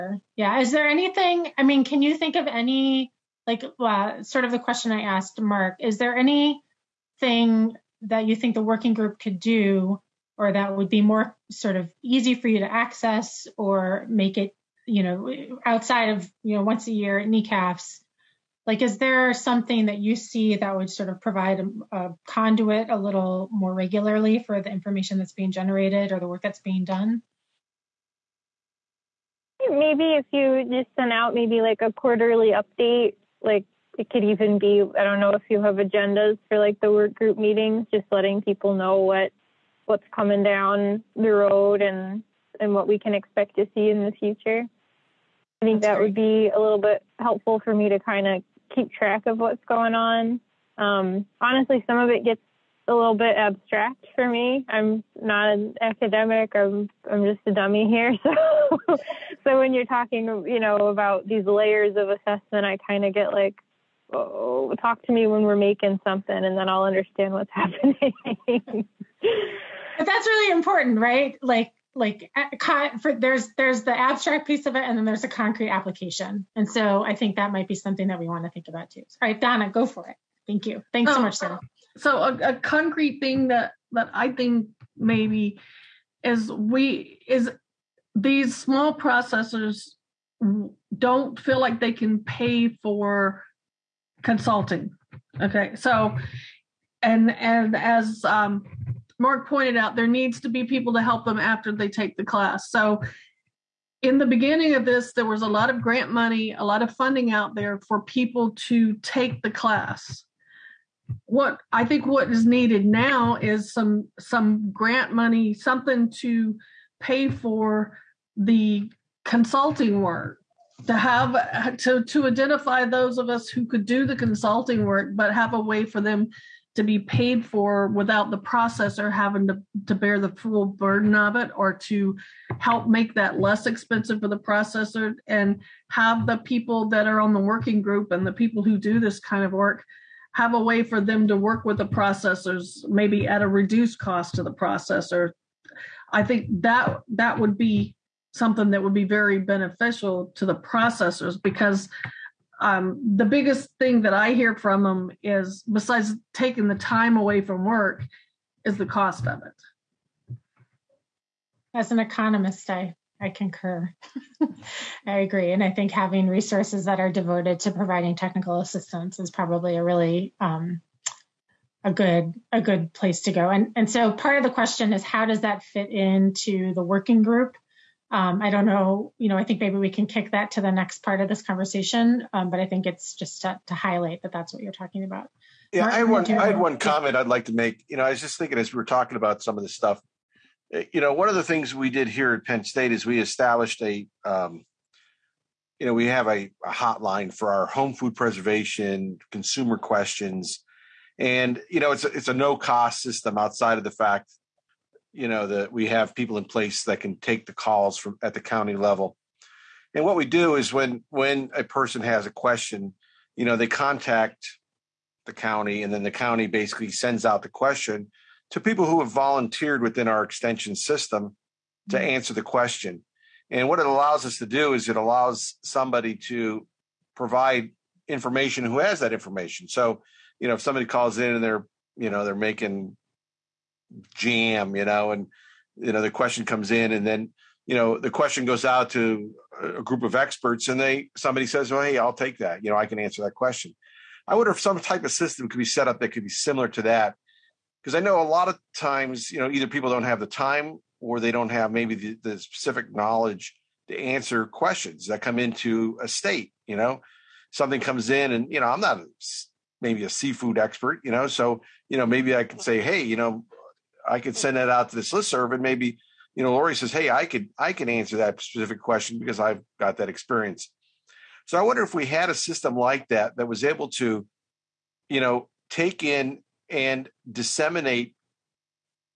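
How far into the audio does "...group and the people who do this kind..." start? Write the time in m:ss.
2:17.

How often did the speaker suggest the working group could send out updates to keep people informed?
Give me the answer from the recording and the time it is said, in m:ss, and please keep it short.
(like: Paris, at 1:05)
Quarterly, at 0:31.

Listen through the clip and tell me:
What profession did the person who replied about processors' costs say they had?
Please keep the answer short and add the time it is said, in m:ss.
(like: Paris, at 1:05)
Economist, at 2:41.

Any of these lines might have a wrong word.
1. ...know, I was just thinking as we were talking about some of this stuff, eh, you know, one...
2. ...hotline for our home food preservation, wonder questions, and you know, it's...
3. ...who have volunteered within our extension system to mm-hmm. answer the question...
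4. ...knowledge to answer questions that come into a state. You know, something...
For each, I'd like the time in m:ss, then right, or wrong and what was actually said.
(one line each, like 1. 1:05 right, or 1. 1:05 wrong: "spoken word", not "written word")
1. 3:07 right
2. 3:16 wrong: "consumer", not "wonder"
3. 3:38 right
4. 4:12 right.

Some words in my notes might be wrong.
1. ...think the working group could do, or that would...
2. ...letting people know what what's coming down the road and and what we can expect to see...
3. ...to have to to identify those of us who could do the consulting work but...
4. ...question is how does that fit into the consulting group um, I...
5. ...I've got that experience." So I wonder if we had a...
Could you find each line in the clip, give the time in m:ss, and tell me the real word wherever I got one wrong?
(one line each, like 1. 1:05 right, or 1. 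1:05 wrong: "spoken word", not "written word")
1. 0:08 right
2. 0:38 right
3. 2:00 right
4. 2:54 wrong: "working", not "consulting"
5. 4:29 right.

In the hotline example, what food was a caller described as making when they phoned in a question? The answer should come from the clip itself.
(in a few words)
Jam.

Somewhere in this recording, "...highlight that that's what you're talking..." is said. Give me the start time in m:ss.
3:03.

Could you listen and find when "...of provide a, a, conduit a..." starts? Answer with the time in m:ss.
0:21.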